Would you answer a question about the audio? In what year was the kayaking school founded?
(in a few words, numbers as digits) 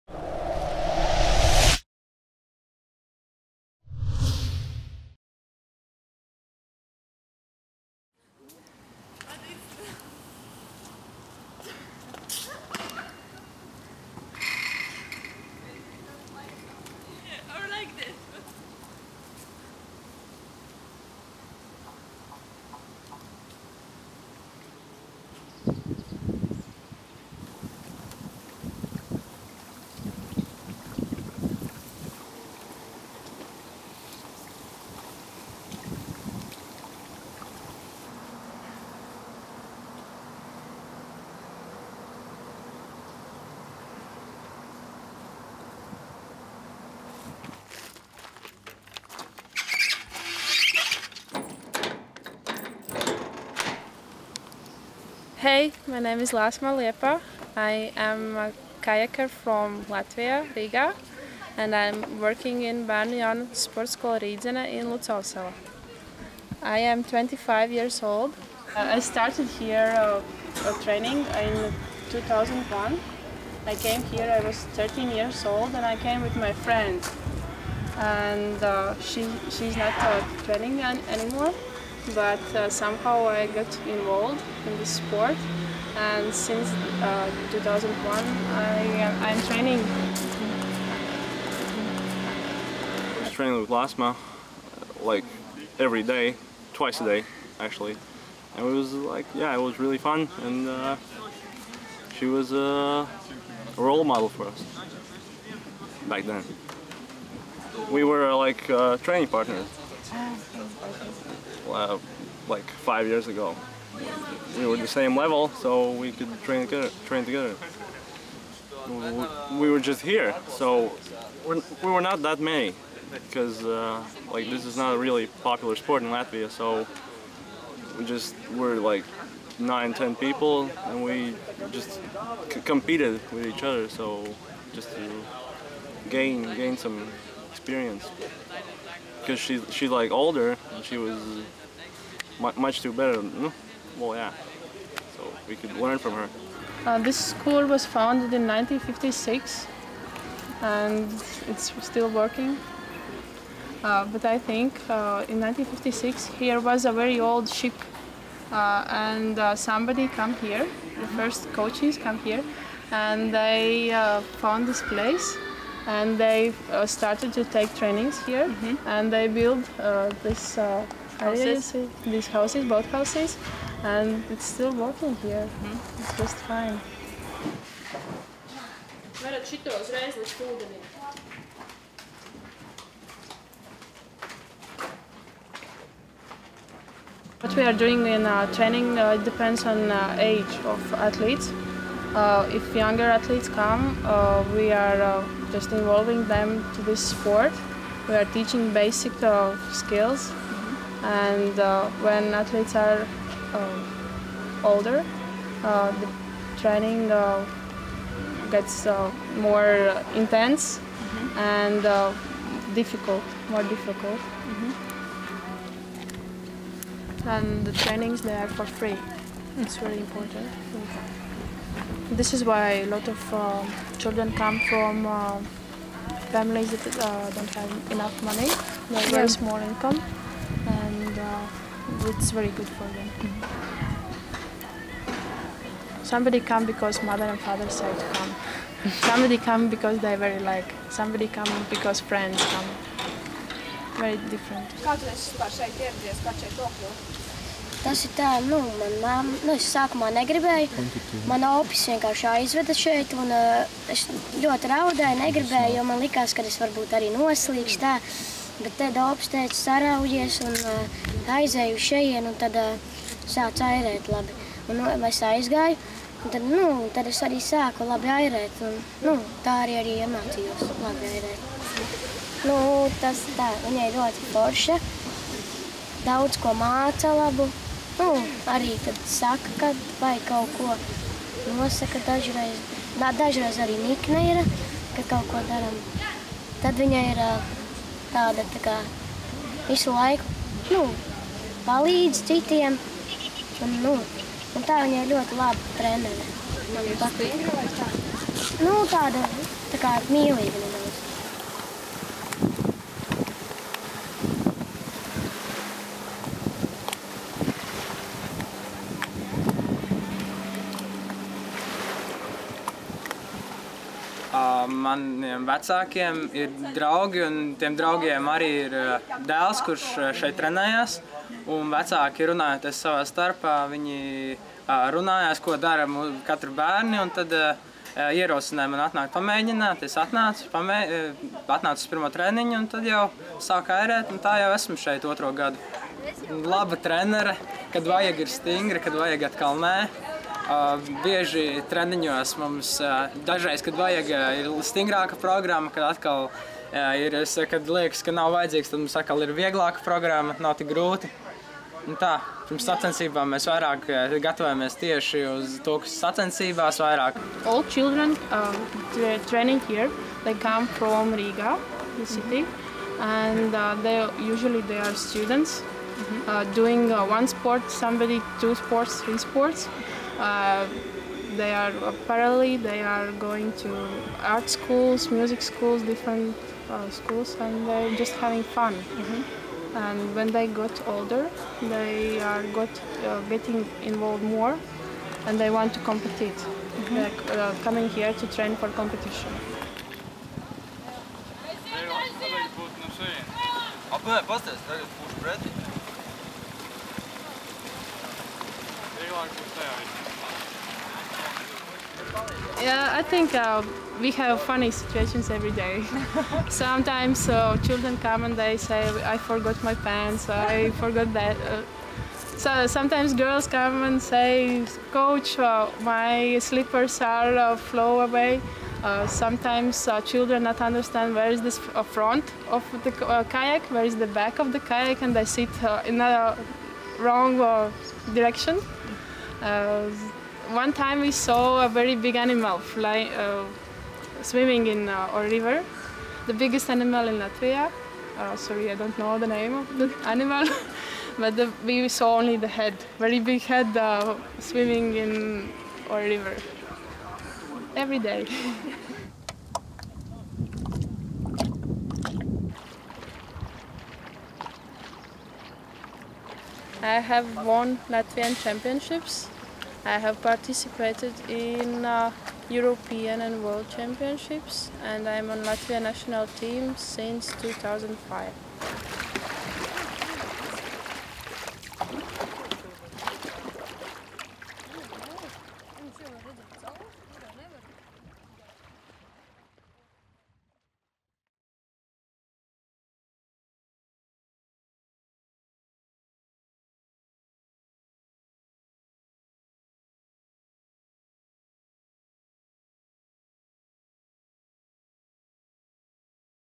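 1956.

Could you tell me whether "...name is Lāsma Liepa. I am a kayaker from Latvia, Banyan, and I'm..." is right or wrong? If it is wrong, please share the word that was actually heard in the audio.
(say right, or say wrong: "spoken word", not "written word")
wrong: "Riga", not "Banyan".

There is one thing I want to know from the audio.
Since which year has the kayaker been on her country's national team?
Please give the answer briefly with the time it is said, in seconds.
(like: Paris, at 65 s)
2005, at 466 s.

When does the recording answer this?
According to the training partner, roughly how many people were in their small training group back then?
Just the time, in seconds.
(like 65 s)
129 s.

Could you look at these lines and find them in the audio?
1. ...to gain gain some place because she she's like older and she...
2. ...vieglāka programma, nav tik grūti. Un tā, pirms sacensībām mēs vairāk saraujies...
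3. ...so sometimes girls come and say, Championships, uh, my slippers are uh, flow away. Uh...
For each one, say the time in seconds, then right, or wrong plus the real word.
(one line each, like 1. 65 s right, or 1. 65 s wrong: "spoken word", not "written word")
1. 134 s wrong: "experience", not "place"
2. 349 s wrong: "gatavojamies", not "saraujies"
3. 412 s wrong: "Coach", not "Championships".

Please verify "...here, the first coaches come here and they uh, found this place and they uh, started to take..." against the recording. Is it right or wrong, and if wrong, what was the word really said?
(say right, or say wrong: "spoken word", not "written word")
right.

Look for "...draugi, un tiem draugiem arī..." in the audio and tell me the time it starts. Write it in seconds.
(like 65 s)
316 s.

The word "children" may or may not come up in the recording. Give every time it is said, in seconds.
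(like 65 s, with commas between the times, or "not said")
223 s, 357 s, 407 s, 420 s.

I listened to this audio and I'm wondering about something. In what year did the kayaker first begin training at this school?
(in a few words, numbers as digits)
2001.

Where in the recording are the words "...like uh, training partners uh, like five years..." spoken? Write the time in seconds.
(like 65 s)
108 s.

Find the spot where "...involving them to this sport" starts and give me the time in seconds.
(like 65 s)
195 s.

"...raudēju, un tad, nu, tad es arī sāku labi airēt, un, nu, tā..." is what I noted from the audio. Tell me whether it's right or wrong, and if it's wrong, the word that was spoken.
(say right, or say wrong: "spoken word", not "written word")
wrong: "aizgāju", not "raudēju".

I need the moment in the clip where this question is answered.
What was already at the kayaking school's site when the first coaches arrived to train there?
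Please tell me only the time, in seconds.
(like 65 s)
156 s.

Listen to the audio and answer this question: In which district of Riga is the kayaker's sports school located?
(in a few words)
Lucavsala.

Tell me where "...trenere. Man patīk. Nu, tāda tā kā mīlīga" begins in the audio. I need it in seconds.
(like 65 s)
295 s.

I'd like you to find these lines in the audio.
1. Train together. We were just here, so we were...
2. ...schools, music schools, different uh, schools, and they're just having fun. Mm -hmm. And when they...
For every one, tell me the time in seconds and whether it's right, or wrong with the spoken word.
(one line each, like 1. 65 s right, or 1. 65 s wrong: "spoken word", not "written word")
1. 117 s right
2. 374 s right.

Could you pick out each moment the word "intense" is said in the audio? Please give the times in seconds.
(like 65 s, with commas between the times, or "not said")
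210 s.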